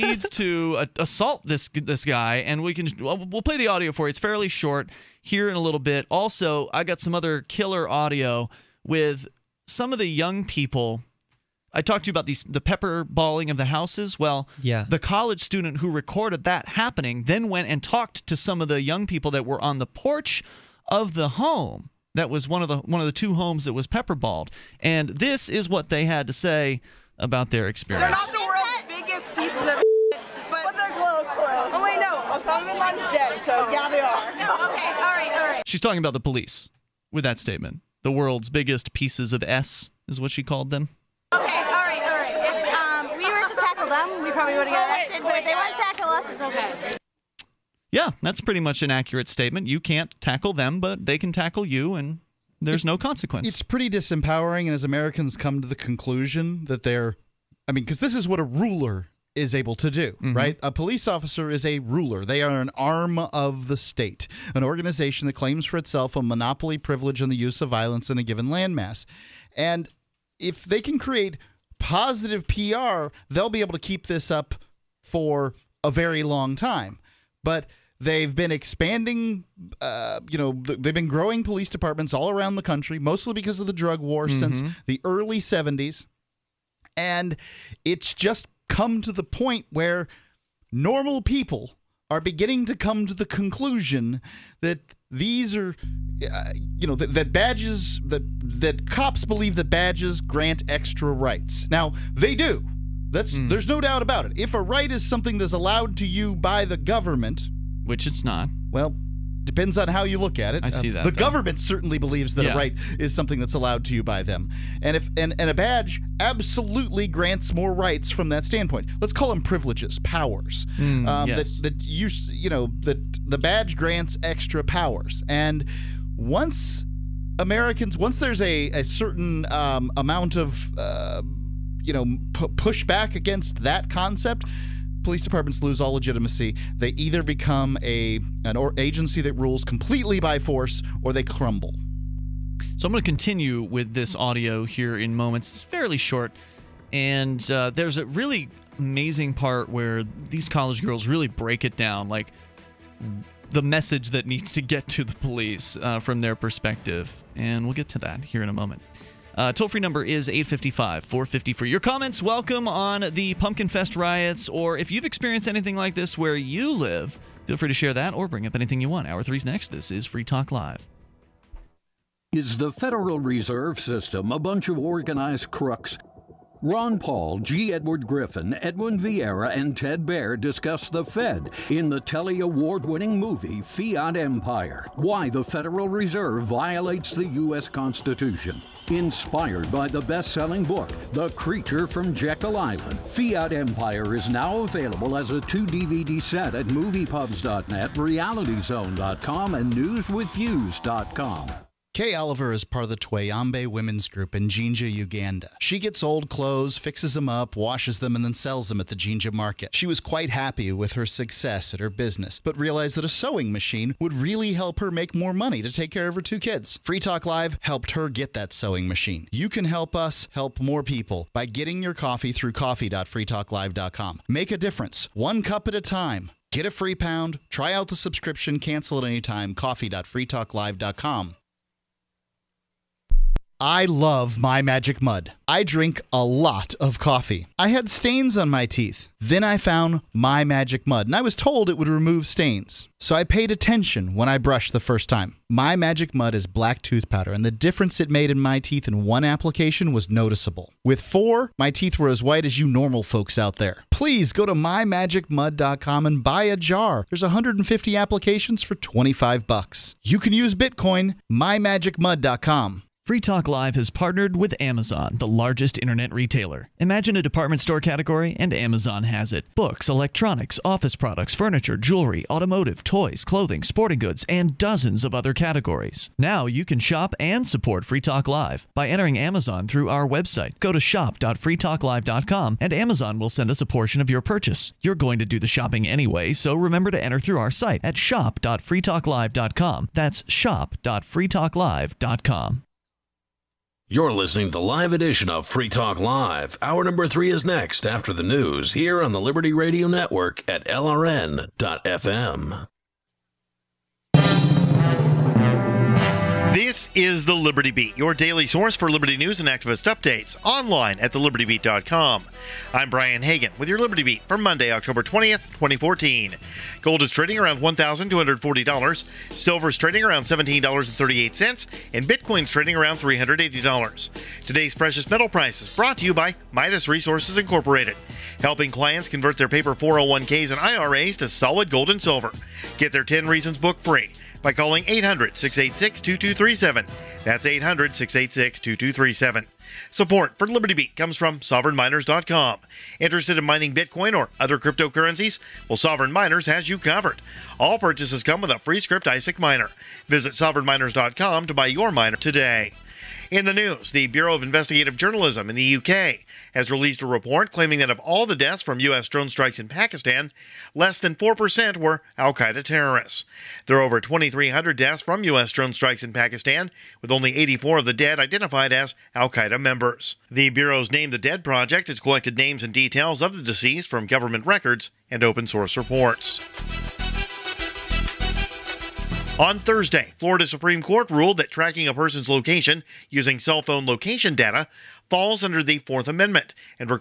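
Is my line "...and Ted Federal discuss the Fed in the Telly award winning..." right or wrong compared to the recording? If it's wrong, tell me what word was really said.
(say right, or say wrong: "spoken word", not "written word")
wrong: "Baer", not "Federal".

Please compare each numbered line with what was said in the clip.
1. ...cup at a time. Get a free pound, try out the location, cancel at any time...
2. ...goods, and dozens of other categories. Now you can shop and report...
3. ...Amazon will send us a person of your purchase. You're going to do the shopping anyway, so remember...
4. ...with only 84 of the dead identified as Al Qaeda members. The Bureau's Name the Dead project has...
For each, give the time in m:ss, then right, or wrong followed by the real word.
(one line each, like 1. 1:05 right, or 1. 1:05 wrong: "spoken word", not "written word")
1. 3:45 wrong: "subscription", not "location"
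2. 4:33 wrong: "support", not "report"
3. 4:42 wrong: "portion", not "person"
4. 6:07 right.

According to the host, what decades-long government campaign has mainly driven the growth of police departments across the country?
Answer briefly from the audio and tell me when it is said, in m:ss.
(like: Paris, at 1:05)
the drug war, at 1:23.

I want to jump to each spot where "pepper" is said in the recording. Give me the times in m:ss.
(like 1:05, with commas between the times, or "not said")
0:12, 0:23.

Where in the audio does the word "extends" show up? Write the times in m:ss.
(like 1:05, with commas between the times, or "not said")
not said.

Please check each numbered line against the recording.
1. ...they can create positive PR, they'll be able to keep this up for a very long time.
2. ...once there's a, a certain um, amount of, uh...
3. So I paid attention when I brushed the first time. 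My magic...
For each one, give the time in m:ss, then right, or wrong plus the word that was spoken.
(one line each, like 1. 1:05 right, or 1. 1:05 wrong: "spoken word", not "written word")
1. 1:10 right
2. 2:07 right
3. 4:02 right.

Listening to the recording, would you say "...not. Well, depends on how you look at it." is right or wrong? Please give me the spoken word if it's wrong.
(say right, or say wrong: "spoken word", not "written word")
right.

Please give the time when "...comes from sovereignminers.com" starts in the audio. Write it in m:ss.
5:40.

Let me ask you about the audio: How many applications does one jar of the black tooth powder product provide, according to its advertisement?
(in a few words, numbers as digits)
150.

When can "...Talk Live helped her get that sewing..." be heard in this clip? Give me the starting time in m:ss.
3:36.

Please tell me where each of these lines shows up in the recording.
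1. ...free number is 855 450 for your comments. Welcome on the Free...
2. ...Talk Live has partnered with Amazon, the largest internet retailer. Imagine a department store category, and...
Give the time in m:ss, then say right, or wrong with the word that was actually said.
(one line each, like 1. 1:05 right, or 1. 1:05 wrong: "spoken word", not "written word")
1. 2:39 wrong: "Pumpkin", not "Free"
2. 4:23 right.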